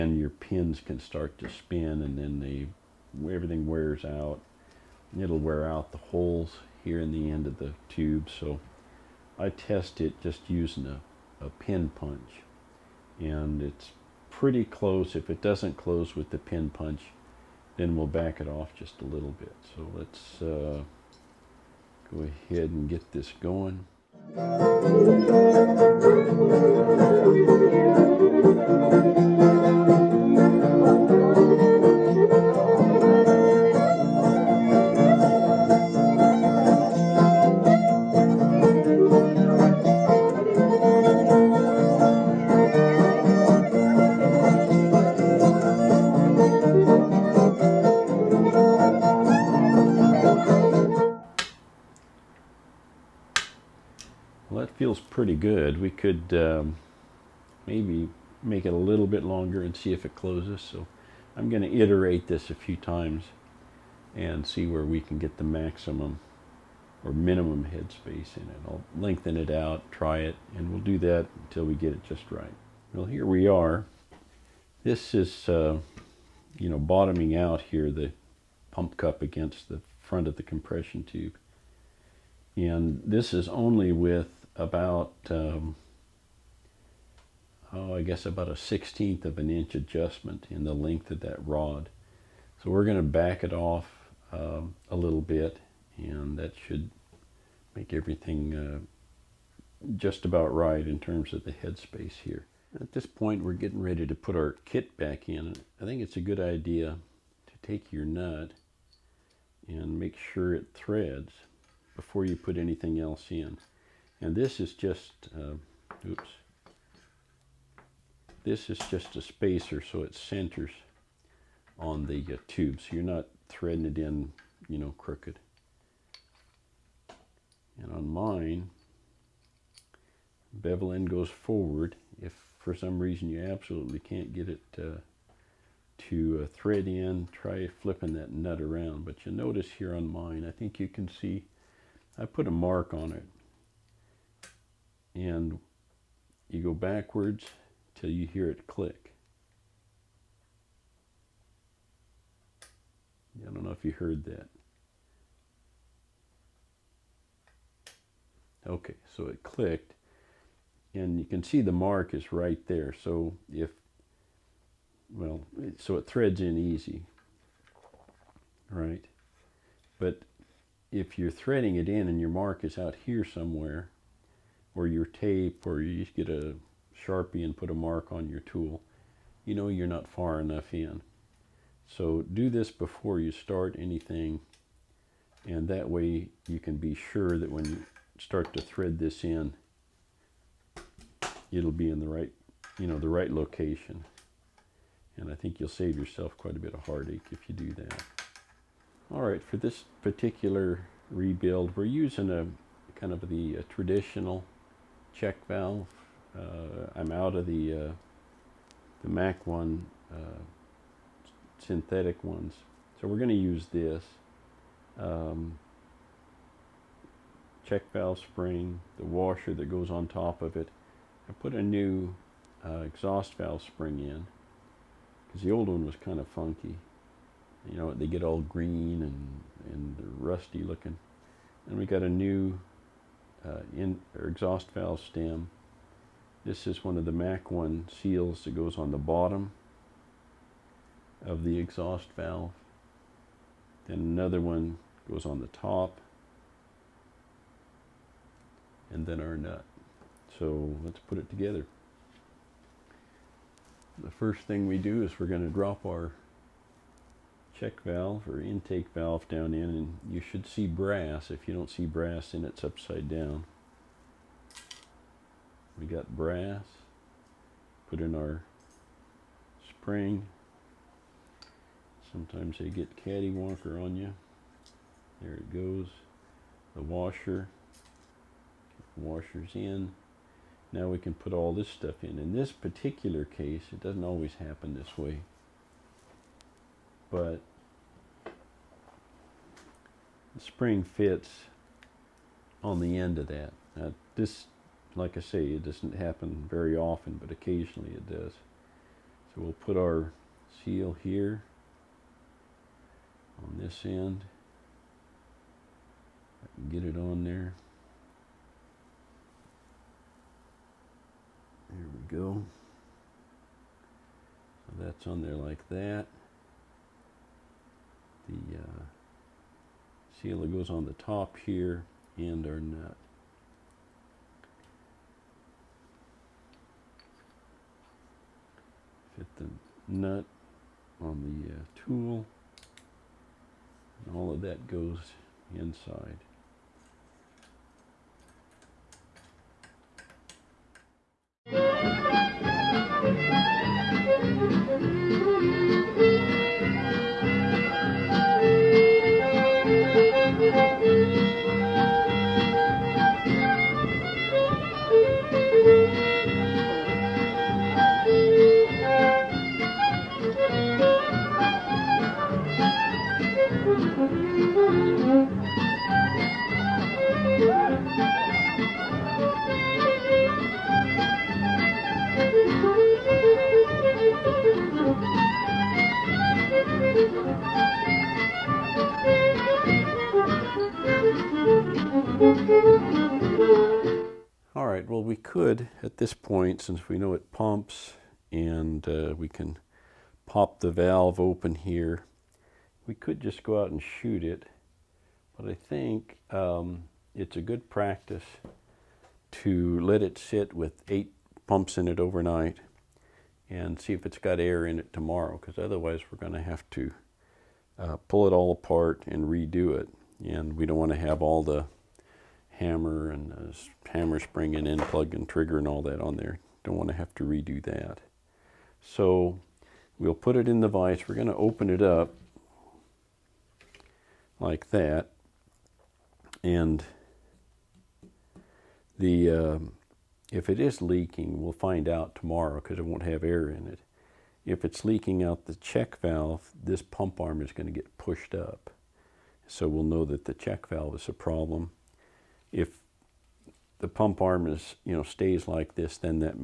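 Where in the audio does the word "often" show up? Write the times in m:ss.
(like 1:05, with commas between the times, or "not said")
4:56.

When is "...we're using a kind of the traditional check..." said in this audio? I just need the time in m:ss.
3:21.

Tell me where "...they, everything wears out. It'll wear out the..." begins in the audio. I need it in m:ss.
0:02.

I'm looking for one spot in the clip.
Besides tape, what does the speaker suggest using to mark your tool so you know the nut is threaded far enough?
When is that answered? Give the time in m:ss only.
2:57.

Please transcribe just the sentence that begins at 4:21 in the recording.
If you don't see brass then it's upside down.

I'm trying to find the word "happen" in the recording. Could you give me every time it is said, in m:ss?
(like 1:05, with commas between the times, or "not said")
4:44, 4:55.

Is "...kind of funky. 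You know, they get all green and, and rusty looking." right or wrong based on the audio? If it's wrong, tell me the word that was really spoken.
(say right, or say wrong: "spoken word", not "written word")
right.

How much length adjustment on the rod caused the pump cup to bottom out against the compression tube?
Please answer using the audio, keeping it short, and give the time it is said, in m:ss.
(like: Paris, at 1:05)
1/16 inch, at 1:28.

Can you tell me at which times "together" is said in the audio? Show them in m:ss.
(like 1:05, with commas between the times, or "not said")
4:11.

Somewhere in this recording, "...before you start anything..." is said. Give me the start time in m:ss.
3:02.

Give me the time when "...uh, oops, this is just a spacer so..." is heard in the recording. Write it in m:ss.
1:55.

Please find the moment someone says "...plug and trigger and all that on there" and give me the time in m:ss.
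6:54.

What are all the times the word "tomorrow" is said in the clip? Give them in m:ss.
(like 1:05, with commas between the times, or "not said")
6:44, 7:12.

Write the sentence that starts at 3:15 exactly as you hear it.
And I think you'll save yourself quite a bit of heartache if you do that.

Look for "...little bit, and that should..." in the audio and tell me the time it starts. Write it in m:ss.
1:34.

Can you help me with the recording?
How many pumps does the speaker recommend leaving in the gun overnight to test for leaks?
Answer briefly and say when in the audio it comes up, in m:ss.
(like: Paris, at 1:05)
8, at 6:40.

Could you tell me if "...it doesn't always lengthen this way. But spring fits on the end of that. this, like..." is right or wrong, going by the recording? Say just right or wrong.
wrong.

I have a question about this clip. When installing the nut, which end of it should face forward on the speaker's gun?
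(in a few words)
Bevel end.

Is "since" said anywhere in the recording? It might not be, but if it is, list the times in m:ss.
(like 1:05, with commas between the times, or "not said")
6:26.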